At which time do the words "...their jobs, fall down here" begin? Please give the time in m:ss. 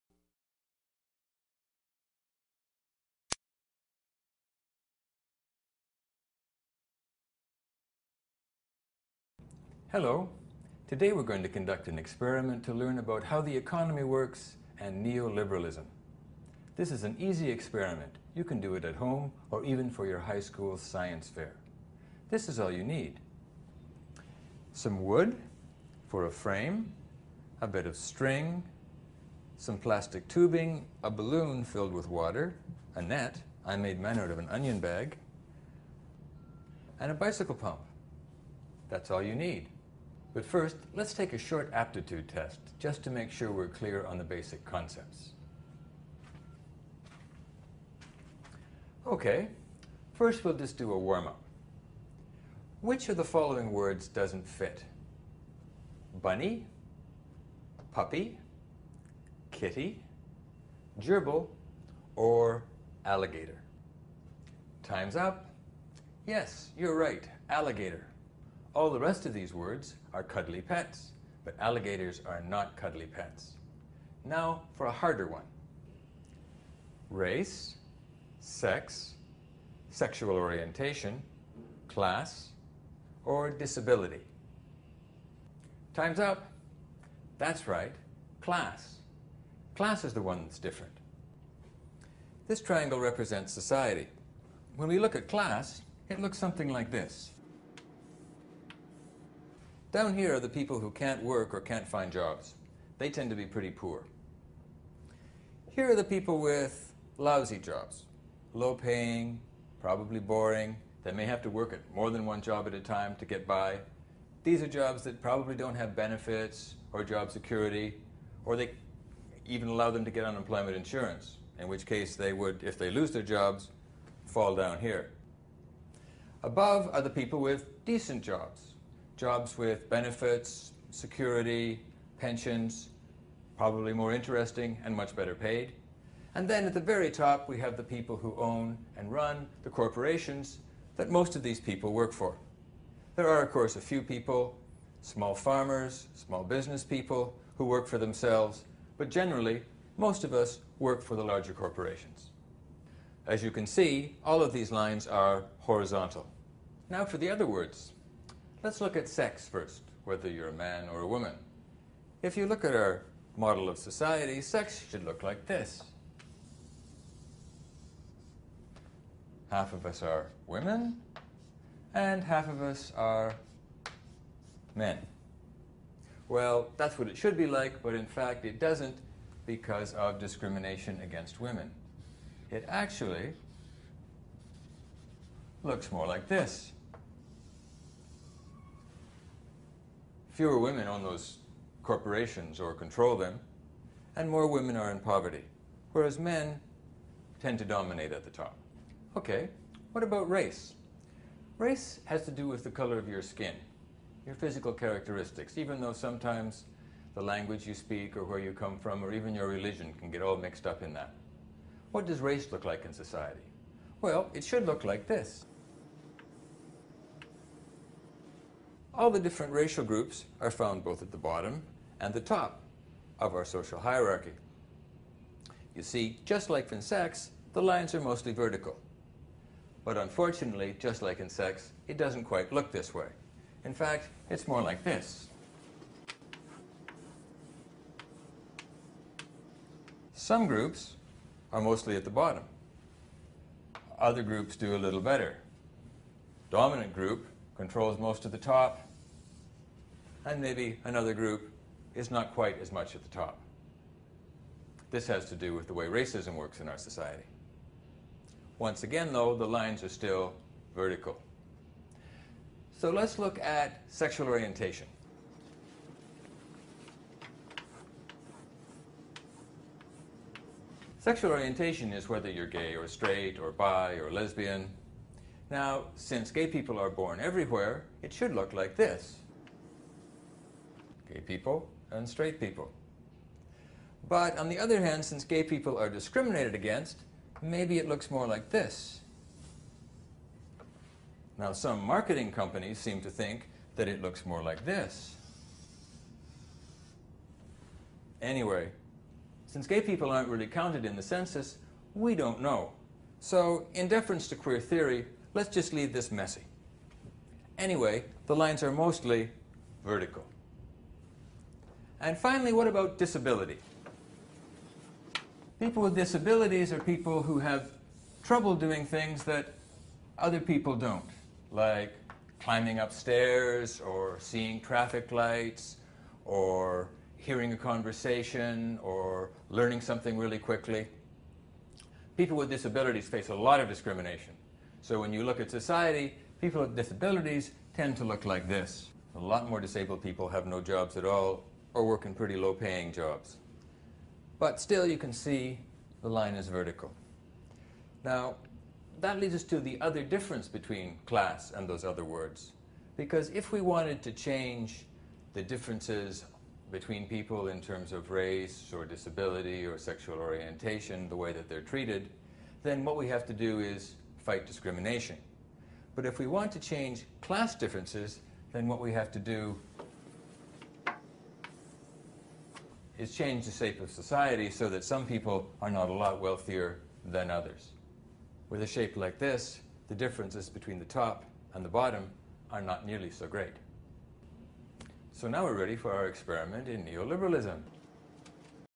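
2:03.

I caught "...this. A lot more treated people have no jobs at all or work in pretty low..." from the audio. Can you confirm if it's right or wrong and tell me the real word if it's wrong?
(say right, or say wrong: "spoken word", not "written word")
wrong: "disabled", not "treated".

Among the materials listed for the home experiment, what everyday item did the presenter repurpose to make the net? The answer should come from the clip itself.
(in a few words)
an onion bag.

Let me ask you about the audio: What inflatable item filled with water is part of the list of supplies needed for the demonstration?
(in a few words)
a balloon.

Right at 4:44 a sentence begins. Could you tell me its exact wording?
But on the other hand, since gay people are discriminated against, maybe it looks more like this.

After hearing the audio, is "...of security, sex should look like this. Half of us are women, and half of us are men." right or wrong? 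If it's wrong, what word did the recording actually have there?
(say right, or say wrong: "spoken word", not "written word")
wrong: "society", not "security".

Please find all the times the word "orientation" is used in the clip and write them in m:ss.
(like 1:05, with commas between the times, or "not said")
1:20, 4:24, 4:31, 6:00.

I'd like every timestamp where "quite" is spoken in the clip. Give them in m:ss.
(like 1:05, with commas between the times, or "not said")
3:52, 4:12.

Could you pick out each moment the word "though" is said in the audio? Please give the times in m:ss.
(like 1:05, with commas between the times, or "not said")
3:25, 4:19.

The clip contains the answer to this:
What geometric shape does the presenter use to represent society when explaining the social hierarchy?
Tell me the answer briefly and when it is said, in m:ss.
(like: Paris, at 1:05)
triangle, at 1:32.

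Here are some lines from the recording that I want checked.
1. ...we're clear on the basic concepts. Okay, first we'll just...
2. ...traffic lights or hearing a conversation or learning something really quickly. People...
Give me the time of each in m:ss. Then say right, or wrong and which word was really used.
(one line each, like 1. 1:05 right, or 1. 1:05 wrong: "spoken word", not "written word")
1. 0:43 right
2. 5:24 right.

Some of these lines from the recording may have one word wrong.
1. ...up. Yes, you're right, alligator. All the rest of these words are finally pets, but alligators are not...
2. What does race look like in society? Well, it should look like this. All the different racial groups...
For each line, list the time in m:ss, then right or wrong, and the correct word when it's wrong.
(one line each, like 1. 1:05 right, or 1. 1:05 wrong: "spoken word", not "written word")
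1. 1:05 wrong: "cuddly", not "finally"
2. 3:31 right.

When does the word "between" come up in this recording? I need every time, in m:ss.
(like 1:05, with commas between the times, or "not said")
5:50, 5:56, 6:20.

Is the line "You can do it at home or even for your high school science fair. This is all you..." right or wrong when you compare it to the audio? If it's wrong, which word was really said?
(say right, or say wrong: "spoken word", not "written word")
right.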